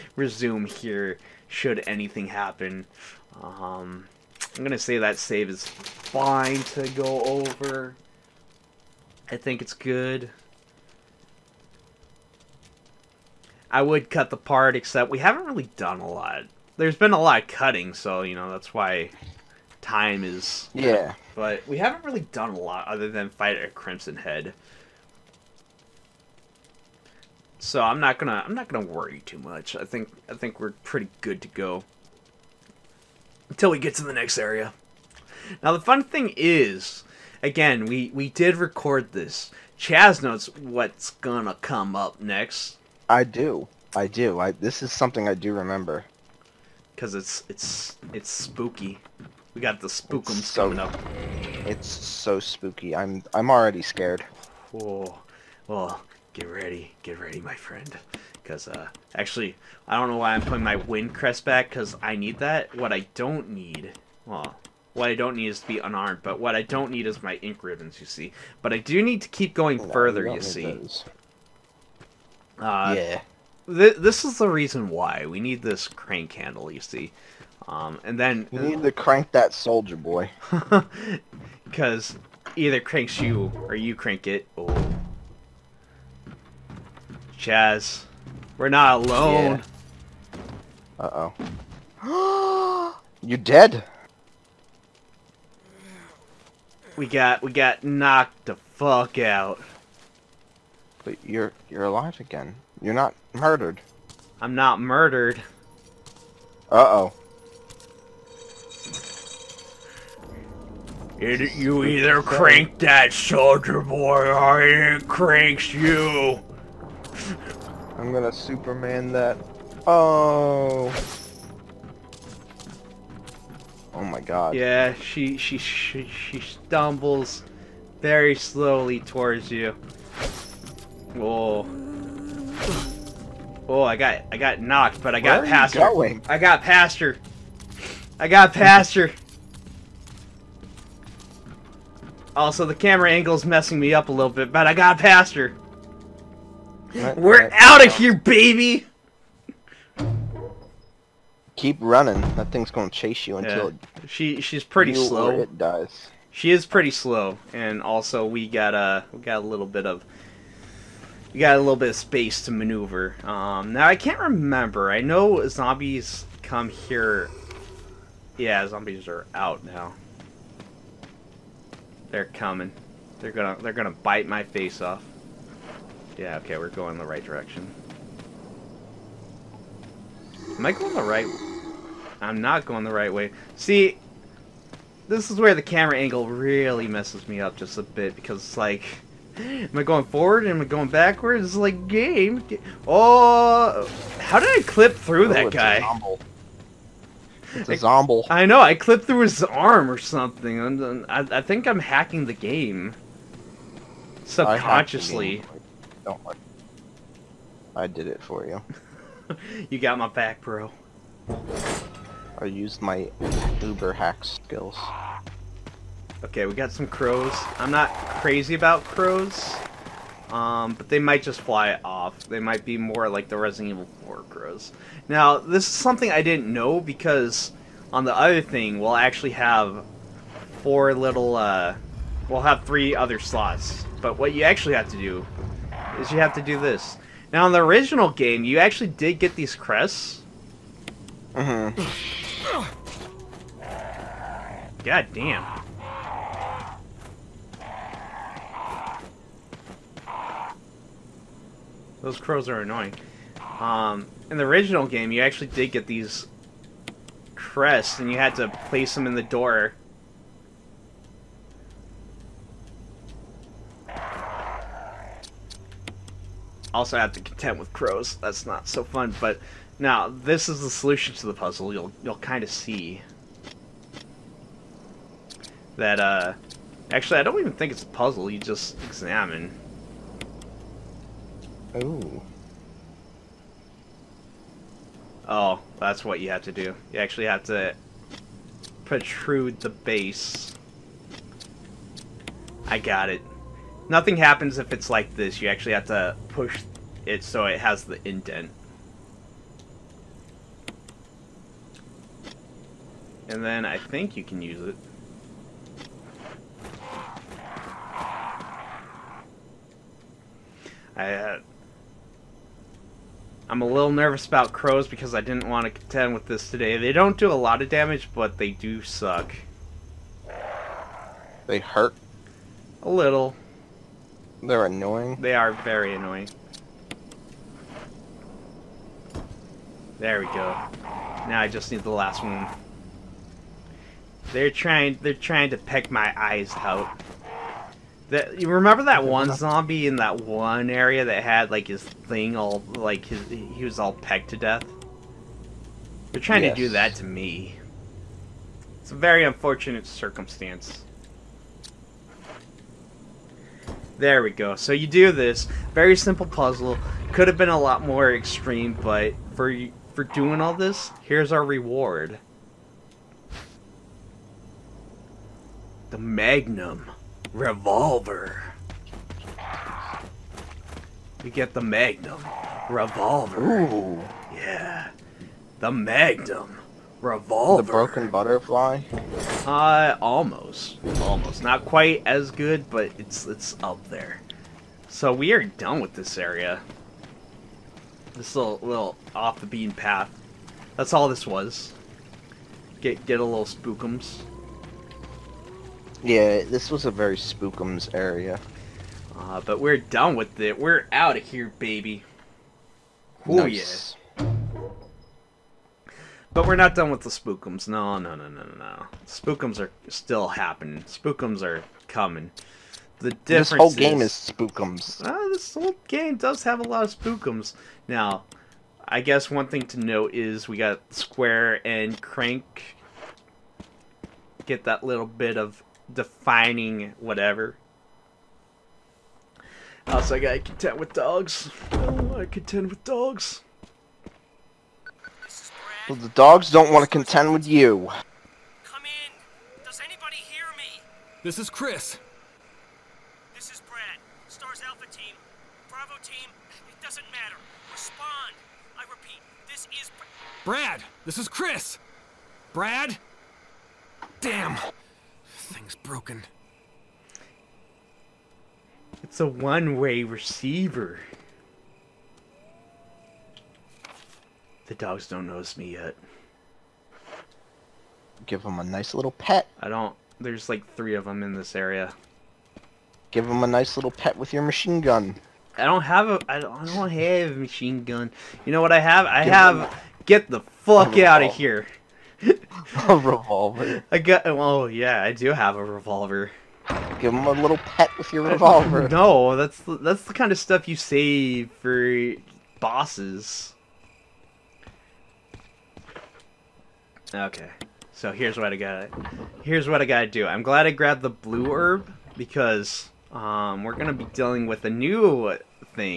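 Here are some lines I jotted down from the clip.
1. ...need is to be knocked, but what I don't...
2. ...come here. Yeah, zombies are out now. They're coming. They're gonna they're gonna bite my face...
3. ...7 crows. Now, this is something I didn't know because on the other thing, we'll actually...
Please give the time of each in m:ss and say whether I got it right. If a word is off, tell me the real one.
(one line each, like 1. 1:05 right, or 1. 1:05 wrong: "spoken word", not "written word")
1. 1:05 wrong: "unarmed", not "knocked"
2. 2:46 right
3. 3:44 wrong: "4", not "7".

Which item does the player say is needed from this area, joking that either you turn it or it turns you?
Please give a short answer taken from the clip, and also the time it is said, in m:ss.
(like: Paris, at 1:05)
Crank handle, at 1:15.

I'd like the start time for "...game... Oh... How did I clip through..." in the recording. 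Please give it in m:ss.
3:11.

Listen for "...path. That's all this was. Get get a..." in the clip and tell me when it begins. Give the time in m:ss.
6:29.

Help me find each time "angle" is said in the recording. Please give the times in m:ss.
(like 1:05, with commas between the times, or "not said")
2:23, 3:05.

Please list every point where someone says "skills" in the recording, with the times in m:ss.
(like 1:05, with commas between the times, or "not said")
3:34.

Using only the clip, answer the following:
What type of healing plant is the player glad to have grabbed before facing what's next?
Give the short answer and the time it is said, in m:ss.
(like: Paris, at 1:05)
Blue herb, at 8:21.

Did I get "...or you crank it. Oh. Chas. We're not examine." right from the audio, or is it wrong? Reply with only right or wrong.
wrong.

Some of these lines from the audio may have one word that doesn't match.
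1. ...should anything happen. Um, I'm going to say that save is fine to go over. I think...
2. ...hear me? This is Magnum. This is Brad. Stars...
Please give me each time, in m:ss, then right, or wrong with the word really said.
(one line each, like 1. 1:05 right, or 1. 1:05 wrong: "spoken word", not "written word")
1. 0:01 right
2. 7:20 wrong: "Chris", not "Magnum".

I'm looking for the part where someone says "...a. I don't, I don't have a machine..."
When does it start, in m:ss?
7:56.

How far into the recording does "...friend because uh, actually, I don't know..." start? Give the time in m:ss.
0:57.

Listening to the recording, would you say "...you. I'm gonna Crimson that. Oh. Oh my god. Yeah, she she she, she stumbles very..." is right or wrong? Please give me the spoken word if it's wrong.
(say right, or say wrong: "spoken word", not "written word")
wrong: "Superman", not "Crimson".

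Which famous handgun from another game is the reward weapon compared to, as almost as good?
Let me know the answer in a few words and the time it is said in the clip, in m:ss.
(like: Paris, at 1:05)
Broken Butterfly, at 6:17.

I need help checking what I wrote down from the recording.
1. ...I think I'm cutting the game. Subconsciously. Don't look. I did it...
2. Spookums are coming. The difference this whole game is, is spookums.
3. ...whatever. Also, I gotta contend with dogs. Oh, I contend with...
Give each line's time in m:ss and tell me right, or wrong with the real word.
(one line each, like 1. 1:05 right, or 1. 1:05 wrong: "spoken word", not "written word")
1. 3:21 wrong: "hacking", not "cutting"
2. 6:50 right
3. 7:06 right.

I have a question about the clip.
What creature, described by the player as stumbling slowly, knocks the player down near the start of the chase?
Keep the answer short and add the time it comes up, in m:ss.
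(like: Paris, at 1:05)
Crimson Head, at 0:23.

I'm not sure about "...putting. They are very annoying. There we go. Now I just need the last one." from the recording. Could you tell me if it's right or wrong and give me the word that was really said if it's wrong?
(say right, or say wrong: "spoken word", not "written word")
wrong: "annoying", not "putting".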